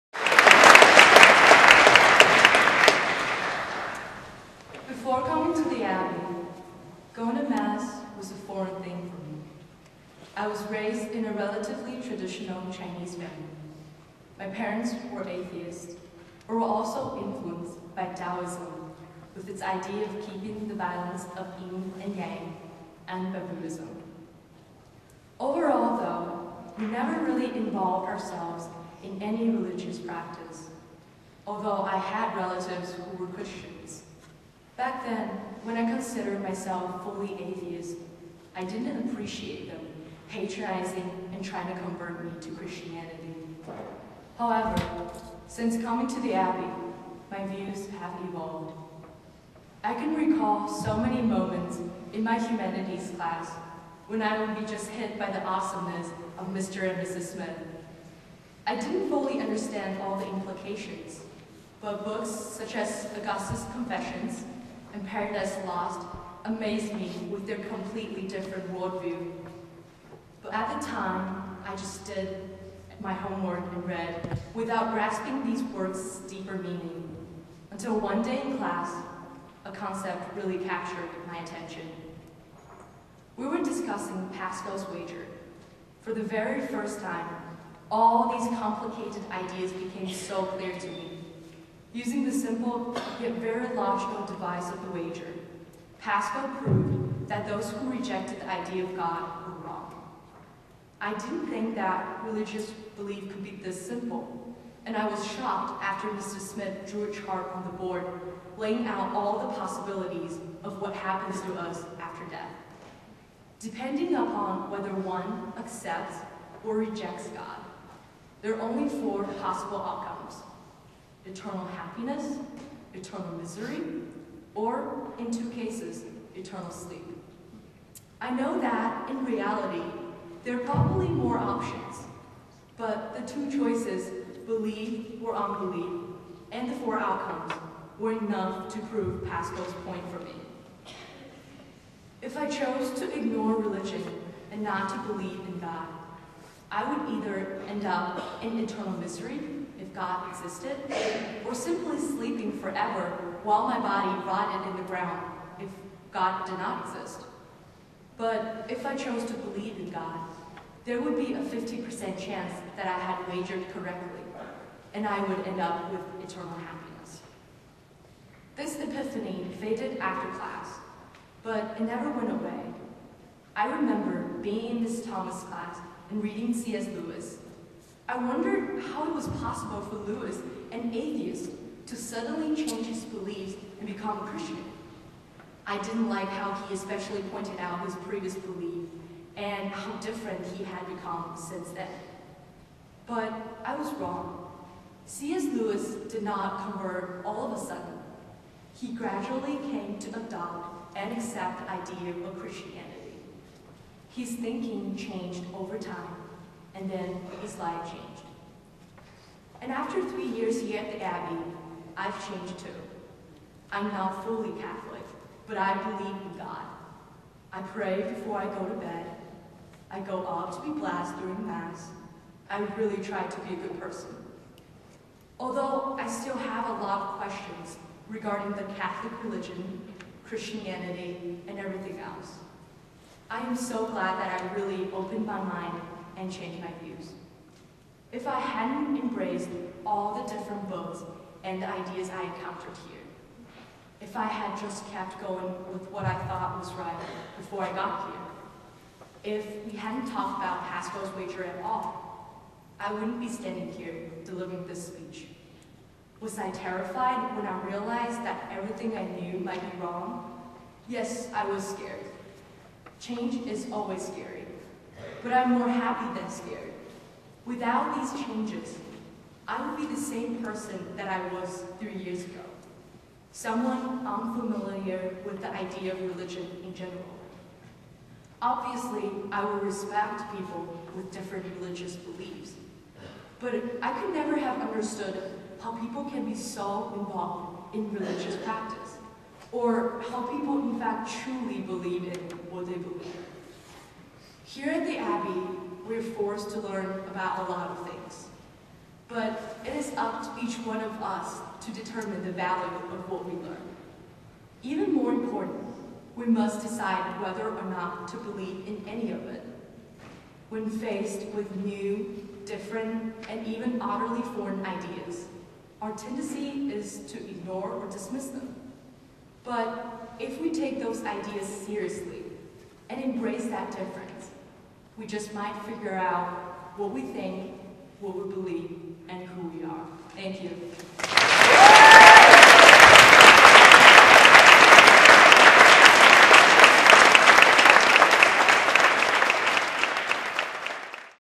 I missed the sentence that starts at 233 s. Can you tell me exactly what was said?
I am so glad that I really opened my mind and changed my views.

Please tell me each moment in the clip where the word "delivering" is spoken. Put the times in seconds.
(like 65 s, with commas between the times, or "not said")
254 s.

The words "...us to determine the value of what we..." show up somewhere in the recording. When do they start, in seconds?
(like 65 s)
300 s.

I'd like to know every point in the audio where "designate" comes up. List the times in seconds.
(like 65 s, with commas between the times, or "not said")
not said.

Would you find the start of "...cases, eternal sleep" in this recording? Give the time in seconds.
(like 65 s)
125 s.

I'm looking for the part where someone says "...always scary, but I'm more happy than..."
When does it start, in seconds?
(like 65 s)
263 s.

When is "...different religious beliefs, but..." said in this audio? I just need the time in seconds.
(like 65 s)
281 s.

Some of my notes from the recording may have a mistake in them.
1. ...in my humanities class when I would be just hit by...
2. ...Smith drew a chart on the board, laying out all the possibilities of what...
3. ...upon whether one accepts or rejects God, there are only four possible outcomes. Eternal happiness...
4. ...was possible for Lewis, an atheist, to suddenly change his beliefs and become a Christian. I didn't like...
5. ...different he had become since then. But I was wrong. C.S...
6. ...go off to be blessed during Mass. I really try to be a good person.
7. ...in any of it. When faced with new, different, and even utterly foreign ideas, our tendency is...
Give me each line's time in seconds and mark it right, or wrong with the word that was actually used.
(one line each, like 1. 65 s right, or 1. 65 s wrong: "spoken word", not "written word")
1. 52 s right
2. 106 s right
3. 114 s right
4. 179 s right
5. 189 s right
6. 219 s right
7. 308 s right.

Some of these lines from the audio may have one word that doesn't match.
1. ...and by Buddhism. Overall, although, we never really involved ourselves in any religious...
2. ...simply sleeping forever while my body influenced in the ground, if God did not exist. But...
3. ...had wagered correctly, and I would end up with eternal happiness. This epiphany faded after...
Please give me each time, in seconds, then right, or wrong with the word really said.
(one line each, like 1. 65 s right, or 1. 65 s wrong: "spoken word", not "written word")
1. 23 s wrong: "though", not "although"
2. 151 s wrong: "rotted", not "influenced"
3. 162 s right.